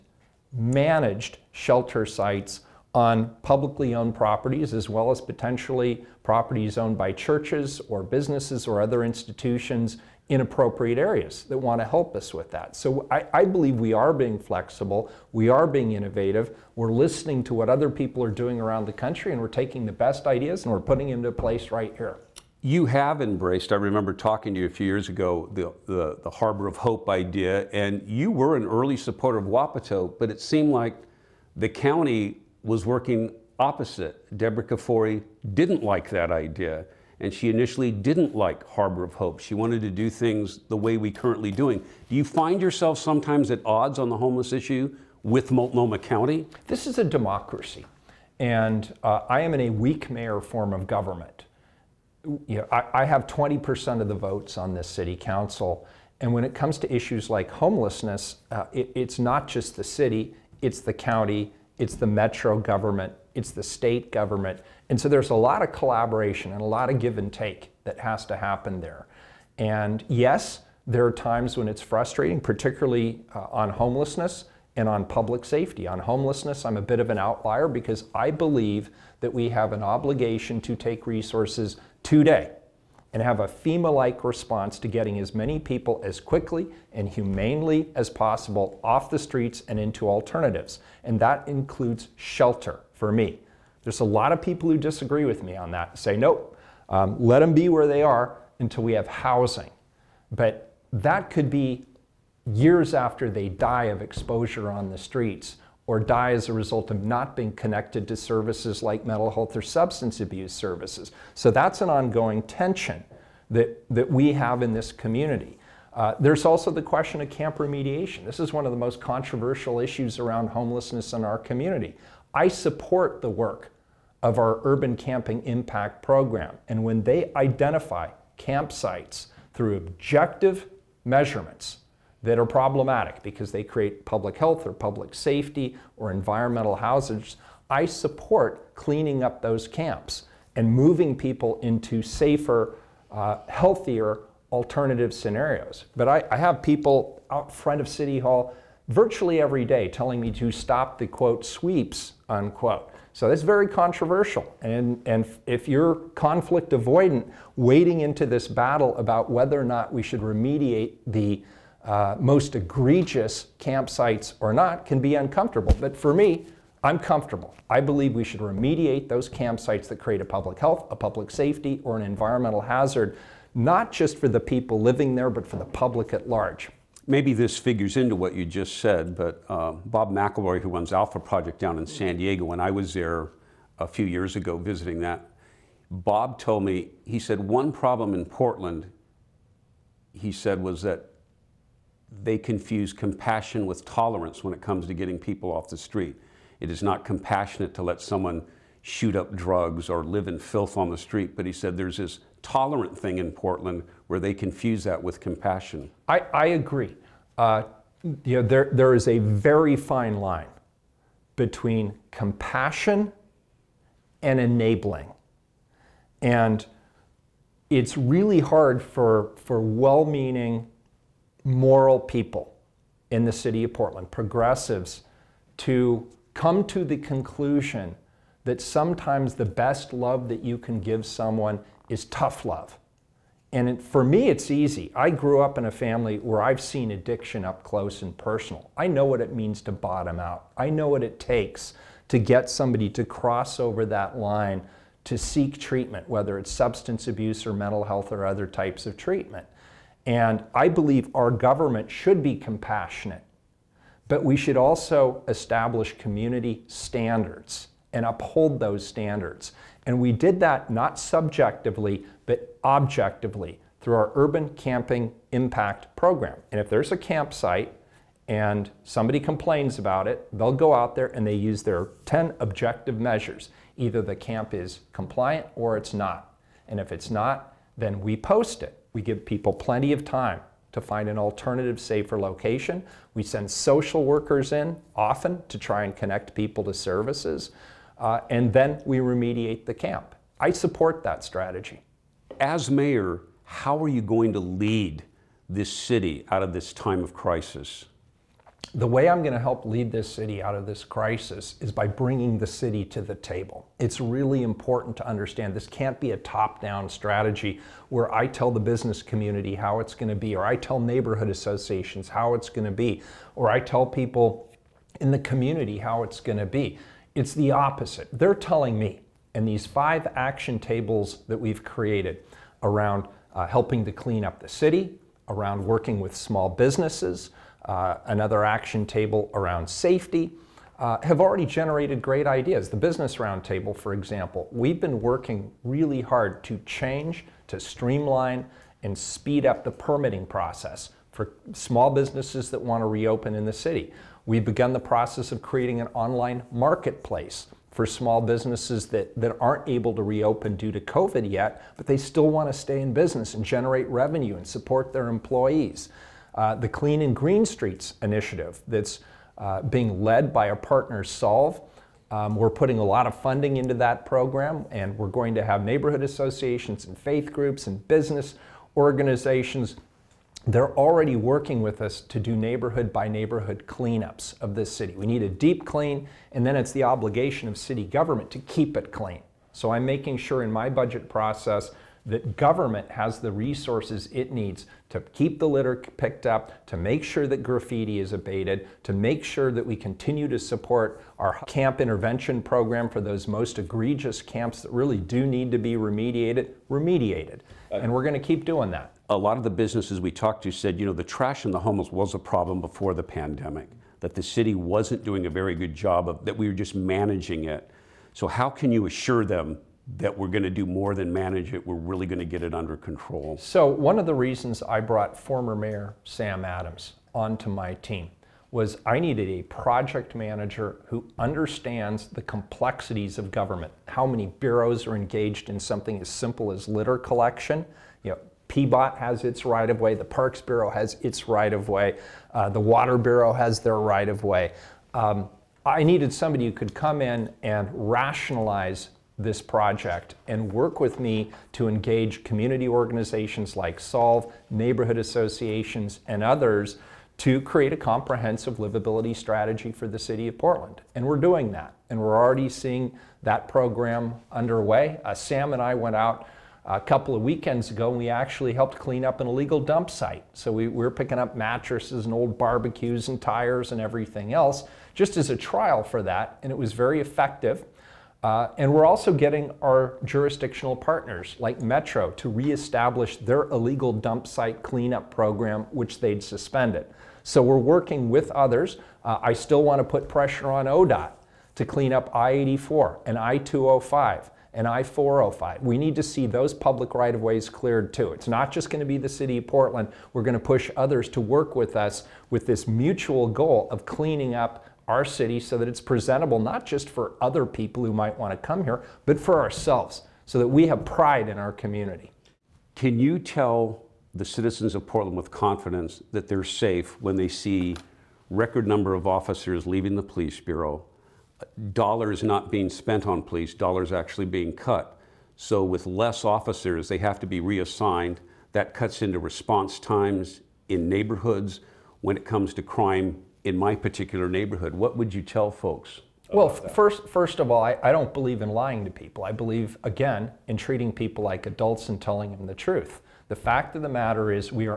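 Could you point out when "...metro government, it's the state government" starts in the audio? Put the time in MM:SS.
01:02.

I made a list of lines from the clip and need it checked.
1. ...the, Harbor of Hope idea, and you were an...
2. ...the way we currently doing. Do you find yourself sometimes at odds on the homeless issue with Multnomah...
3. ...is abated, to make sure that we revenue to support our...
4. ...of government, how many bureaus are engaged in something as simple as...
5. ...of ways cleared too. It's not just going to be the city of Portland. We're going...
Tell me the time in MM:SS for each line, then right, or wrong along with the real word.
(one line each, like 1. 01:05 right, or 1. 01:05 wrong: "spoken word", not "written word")
1. 00:26 right
2. 00:40 right
3. 06:27 wrong: "continue", not "revenue"
4. 07:03 right
5. 08:07 right.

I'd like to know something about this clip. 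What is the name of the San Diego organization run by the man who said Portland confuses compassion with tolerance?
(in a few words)
Alpha Project.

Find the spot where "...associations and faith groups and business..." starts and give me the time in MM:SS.
06:06.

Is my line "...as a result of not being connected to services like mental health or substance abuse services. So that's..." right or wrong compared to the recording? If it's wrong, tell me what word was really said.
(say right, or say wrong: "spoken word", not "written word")
right.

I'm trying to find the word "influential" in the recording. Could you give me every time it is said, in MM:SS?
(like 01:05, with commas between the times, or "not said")
not said.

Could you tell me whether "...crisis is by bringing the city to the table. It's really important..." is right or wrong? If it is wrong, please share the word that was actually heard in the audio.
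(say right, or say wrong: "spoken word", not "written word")
right.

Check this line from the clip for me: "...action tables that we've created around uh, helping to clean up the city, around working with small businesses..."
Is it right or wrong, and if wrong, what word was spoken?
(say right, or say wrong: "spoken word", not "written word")
right.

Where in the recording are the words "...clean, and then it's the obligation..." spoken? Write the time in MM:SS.
06:15.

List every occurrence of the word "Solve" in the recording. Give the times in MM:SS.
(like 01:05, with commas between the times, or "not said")
06:01, 07:23.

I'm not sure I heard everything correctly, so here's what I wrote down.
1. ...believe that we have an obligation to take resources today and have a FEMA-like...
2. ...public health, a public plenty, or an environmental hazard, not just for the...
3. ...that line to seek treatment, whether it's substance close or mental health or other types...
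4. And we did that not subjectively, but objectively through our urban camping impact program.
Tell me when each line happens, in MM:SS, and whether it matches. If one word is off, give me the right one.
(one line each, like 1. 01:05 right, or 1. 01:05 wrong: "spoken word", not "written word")
1. 01:18 right
2. 02:50 wrong: "safety", not "plenty"
3. 04:03 wrong: "abuse", not "close"
4. 04:19 right.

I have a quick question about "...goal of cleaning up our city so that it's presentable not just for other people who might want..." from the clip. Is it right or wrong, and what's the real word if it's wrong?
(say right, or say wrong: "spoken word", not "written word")
right.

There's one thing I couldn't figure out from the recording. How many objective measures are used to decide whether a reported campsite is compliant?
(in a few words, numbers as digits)
10.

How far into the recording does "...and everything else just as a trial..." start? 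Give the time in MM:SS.
07:43.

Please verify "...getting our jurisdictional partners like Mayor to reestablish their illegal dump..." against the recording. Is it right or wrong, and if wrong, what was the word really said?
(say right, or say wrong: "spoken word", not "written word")
wrong: "Metro", not "Mayor".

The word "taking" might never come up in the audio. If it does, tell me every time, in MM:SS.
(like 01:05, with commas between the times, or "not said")
00:19.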